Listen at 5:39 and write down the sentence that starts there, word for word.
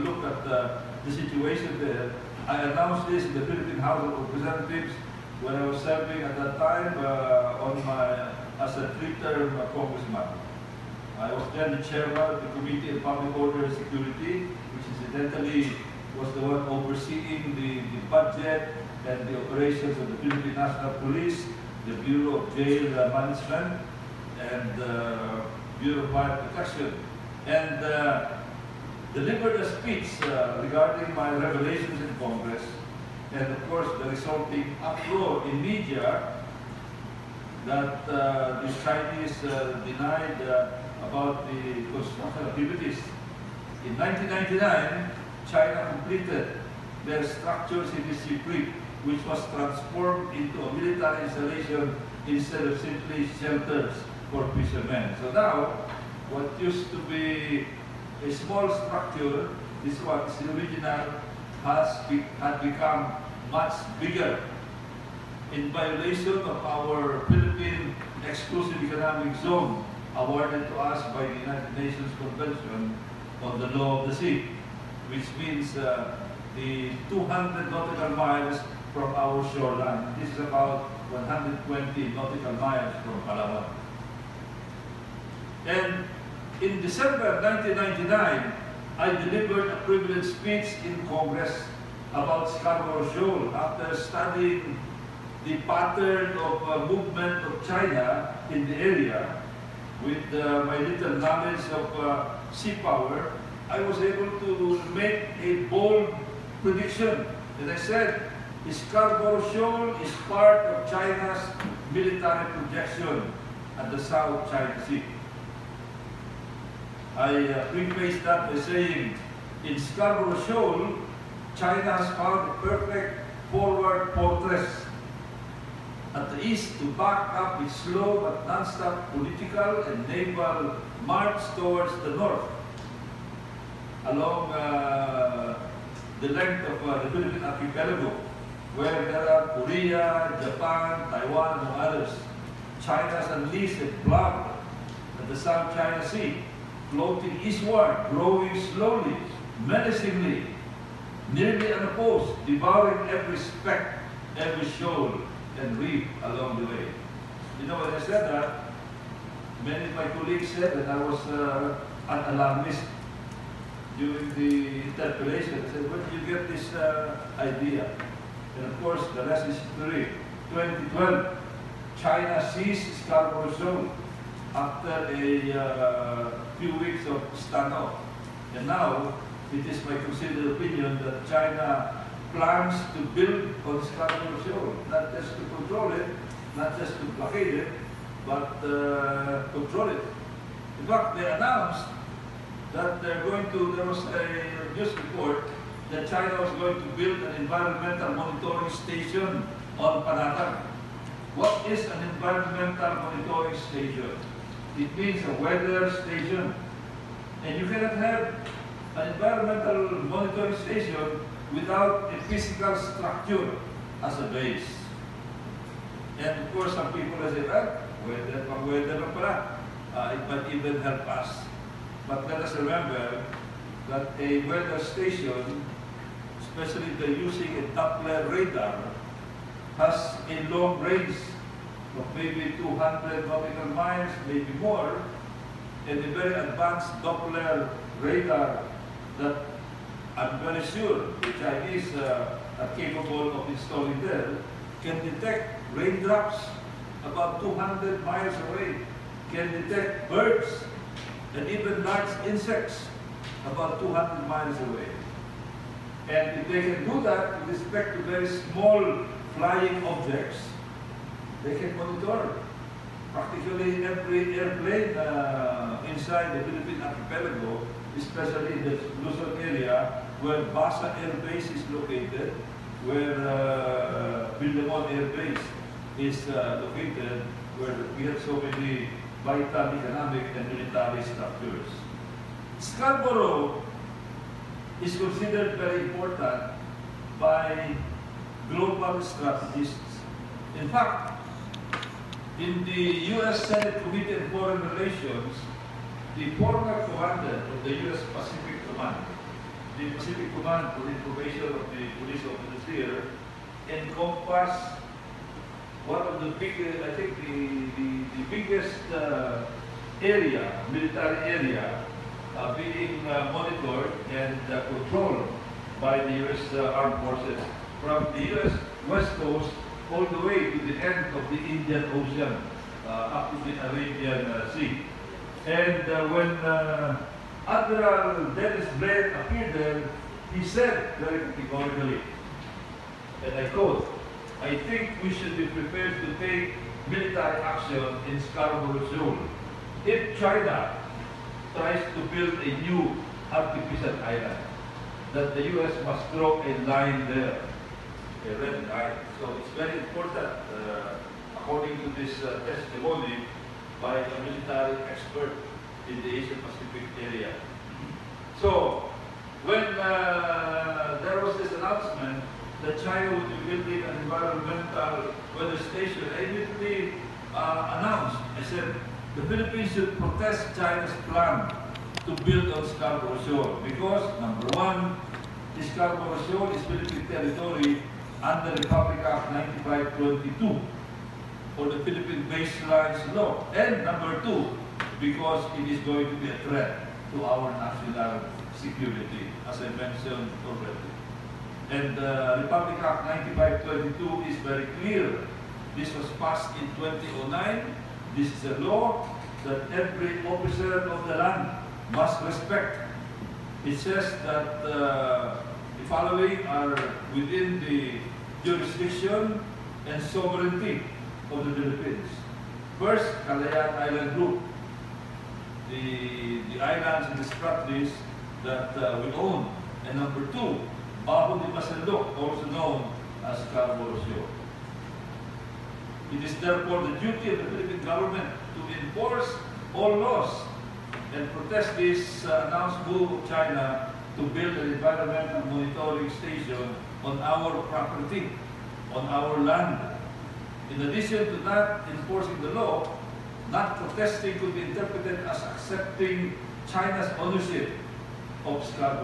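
If China tries to build a new artificial island, that the U.S.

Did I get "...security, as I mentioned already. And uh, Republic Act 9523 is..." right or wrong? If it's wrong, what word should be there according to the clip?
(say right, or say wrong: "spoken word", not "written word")
wrong: "9522", not "9523".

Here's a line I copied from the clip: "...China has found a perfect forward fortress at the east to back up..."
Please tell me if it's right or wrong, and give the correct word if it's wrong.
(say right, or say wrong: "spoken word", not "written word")
right.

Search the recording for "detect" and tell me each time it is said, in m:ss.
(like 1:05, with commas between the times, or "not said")
4:05, 4:09.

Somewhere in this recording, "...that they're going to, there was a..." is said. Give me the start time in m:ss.
3:12.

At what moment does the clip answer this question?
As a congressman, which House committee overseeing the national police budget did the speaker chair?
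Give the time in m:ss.
0:12.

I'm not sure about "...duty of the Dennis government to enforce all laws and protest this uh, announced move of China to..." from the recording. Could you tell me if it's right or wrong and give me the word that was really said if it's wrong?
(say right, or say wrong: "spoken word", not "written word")
wrong: "Philippine", not "Dennis".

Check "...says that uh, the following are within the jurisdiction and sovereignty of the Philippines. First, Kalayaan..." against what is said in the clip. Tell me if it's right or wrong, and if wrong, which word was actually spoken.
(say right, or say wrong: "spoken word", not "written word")
right.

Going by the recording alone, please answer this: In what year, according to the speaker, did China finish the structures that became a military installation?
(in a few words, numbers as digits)
1999.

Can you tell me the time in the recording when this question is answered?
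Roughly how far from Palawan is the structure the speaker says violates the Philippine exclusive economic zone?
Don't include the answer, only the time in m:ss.
1:21.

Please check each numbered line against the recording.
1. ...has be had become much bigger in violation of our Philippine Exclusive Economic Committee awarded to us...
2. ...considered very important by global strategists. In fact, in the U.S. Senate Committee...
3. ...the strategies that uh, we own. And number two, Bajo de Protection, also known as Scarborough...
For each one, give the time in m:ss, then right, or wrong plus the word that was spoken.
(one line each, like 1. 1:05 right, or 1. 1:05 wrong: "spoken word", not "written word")
1. 1:01 wrong: "Zone", not "Committee"
2. 4:44 right
3. 6:57 wrong: "Masinloc", not "Protection".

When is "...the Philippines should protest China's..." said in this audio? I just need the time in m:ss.
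6:09.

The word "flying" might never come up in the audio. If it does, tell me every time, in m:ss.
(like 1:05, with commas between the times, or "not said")
4:19.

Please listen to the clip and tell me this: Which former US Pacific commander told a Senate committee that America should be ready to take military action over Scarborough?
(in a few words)
Admiral Dennis Blair.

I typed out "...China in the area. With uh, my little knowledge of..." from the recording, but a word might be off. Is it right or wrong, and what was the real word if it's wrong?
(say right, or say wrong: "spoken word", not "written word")
right.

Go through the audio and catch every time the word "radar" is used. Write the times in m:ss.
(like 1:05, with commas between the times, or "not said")
3:48, 3:57.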